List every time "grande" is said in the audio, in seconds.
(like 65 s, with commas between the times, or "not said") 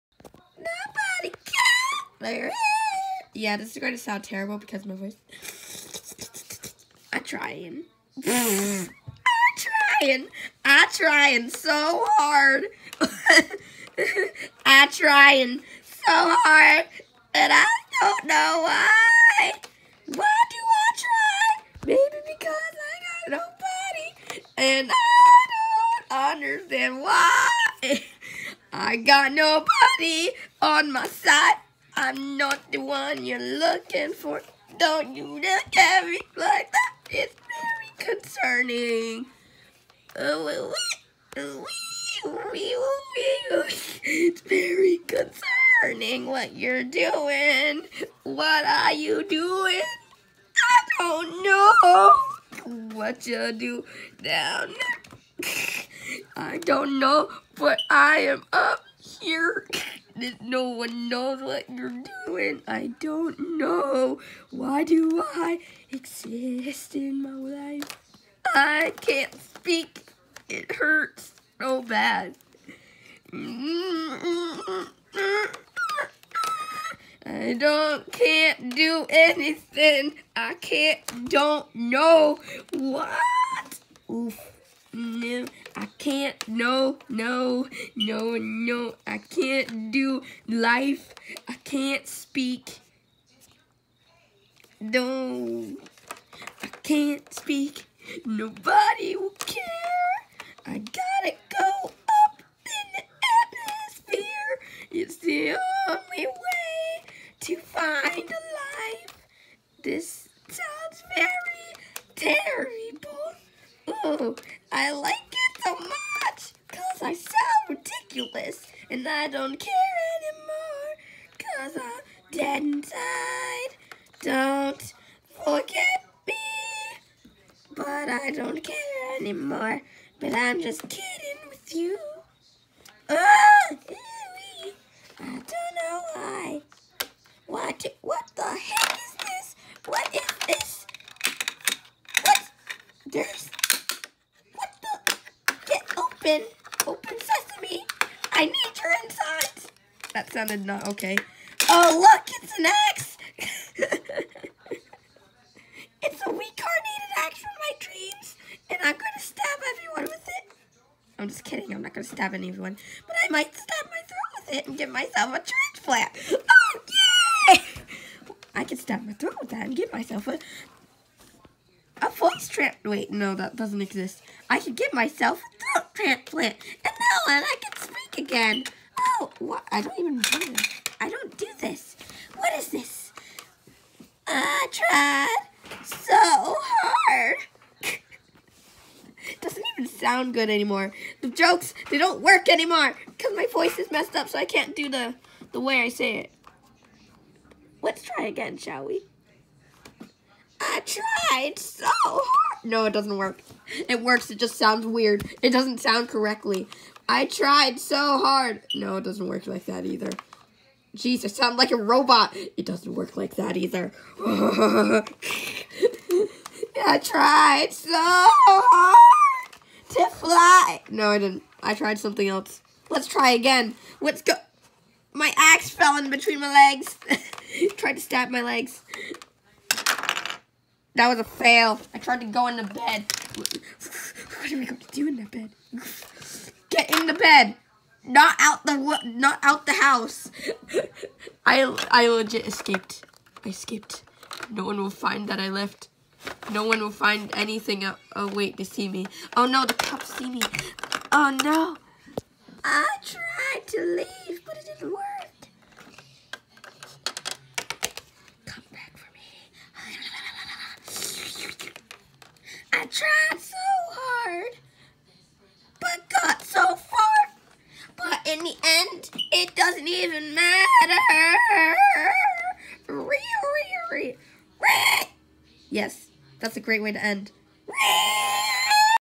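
not said.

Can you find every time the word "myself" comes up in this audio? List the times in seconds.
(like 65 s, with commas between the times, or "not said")
164 s, 169 s, 174 s.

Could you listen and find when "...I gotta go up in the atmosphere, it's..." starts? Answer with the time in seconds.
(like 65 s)
100 s.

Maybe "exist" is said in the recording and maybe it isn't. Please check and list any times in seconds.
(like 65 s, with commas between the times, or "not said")
65 s, 173 s.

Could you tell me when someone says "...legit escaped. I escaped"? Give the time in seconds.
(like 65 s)
242 s.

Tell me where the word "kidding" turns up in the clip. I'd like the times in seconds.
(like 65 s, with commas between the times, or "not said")
130 s, 161 s.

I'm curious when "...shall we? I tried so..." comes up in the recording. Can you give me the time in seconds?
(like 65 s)
198 s.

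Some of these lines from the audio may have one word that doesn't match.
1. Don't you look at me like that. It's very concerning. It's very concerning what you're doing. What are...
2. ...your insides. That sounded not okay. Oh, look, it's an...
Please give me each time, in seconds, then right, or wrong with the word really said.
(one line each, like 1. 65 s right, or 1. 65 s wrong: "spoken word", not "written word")
1. 34 s right
2. 148 s right.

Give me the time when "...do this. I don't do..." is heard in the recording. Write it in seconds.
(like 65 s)
180 s.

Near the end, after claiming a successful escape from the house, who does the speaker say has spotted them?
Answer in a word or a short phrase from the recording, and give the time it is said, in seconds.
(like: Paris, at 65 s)
The cops, at 249 s.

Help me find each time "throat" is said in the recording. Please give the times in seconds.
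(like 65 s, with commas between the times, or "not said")
164 s, 169 s, 175 s.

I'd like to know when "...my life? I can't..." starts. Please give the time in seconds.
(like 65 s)
67 s.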